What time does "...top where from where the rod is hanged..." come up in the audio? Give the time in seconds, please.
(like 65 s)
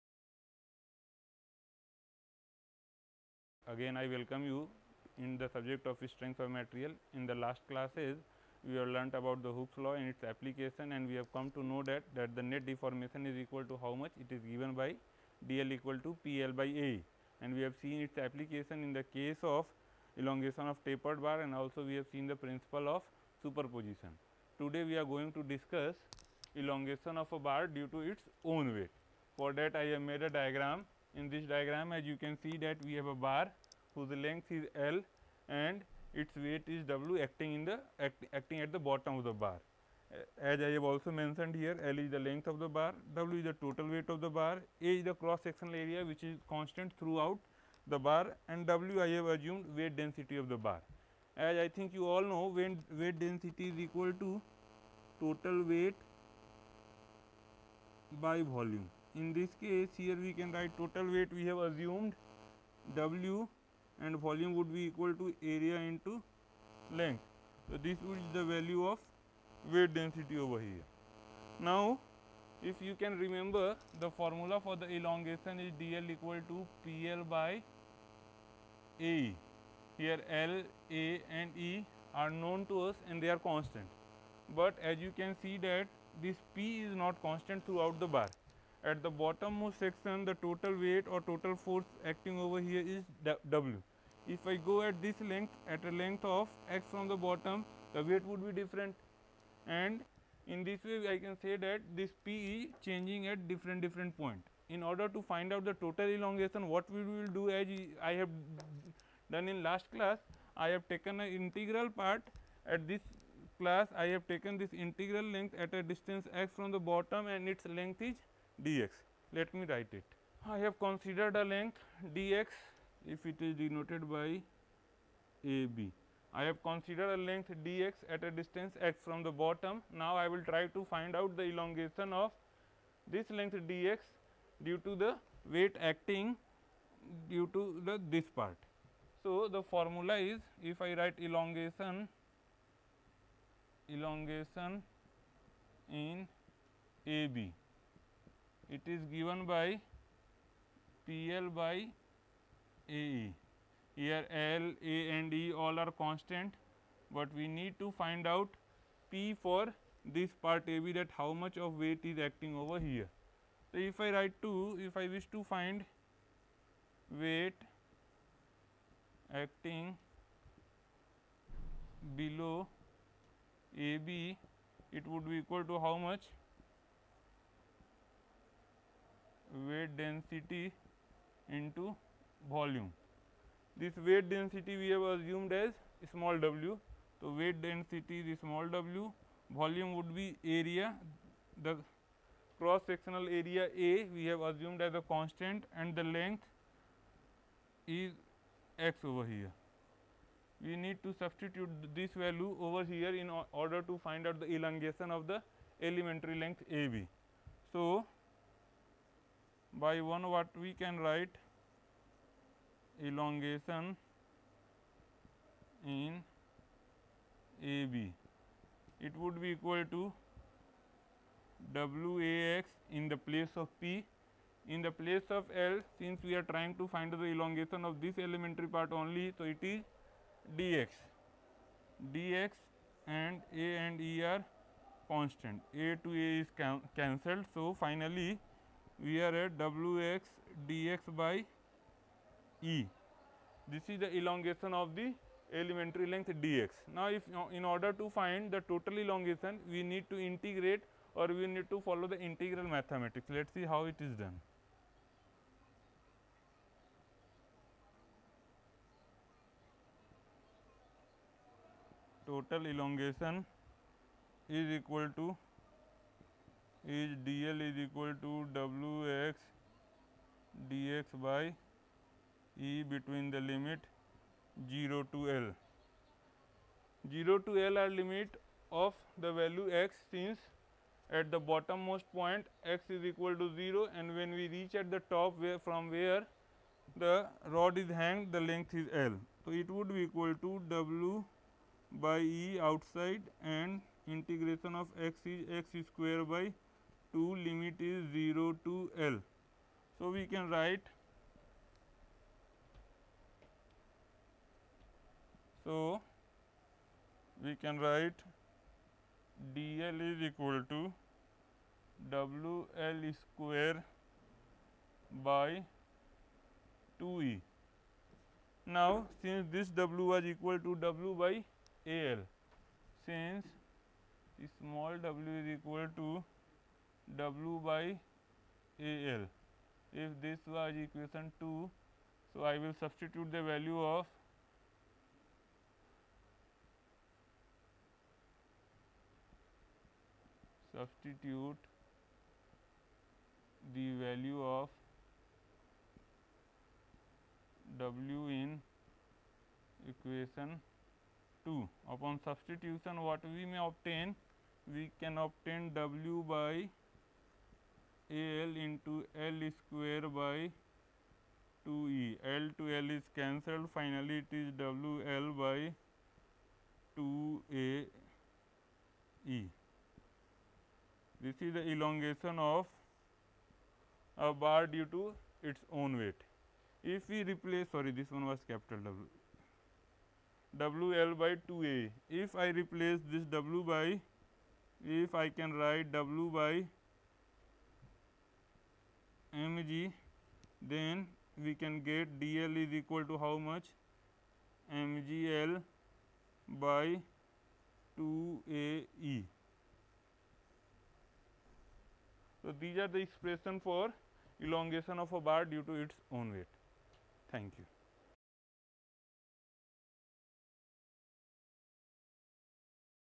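285 s.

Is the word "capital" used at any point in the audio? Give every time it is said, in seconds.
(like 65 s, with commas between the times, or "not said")
378 s.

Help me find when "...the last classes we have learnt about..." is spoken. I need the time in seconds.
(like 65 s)
7 s.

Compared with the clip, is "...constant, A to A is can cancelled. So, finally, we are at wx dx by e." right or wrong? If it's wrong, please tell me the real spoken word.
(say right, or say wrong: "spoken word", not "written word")
right.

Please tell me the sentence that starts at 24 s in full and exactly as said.
Today we are going to discuss elongation of a bar due to its own weight.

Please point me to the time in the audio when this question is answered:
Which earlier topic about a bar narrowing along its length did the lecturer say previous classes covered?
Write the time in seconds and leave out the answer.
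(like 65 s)
20 s.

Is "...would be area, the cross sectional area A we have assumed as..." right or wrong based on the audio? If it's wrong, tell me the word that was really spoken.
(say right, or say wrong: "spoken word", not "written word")
right.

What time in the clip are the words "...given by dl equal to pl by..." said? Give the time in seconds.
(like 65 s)
14 s.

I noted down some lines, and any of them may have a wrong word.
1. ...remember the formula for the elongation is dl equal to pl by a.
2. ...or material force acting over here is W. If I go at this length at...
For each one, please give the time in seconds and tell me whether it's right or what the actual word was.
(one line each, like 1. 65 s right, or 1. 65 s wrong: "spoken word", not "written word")
1. 73 s right
2. 91 s wrong: "total", not "material".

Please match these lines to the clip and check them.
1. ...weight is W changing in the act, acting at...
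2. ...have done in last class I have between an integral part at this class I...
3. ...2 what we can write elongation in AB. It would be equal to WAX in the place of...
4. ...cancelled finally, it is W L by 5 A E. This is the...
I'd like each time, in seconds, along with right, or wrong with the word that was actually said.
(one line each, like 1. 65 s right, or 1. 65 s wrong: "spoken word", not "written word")
1. 36 s wrong: "acting", not "changing"
2. 108 s wrong: "taken", not "between"
3. 210 s wrong: "1", not "2"
4. 363 s wrong: "2", not "5".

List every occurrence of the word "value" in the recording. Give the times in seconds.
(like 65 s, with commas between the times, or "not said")
68 s, 202 s, 279 s, 333 s, 343 s.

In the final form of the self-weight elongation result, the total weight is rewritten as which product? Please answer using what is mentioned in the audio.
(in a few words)
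mg.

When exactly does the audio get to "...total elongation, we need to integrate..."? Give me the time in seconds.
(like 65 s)
248 s.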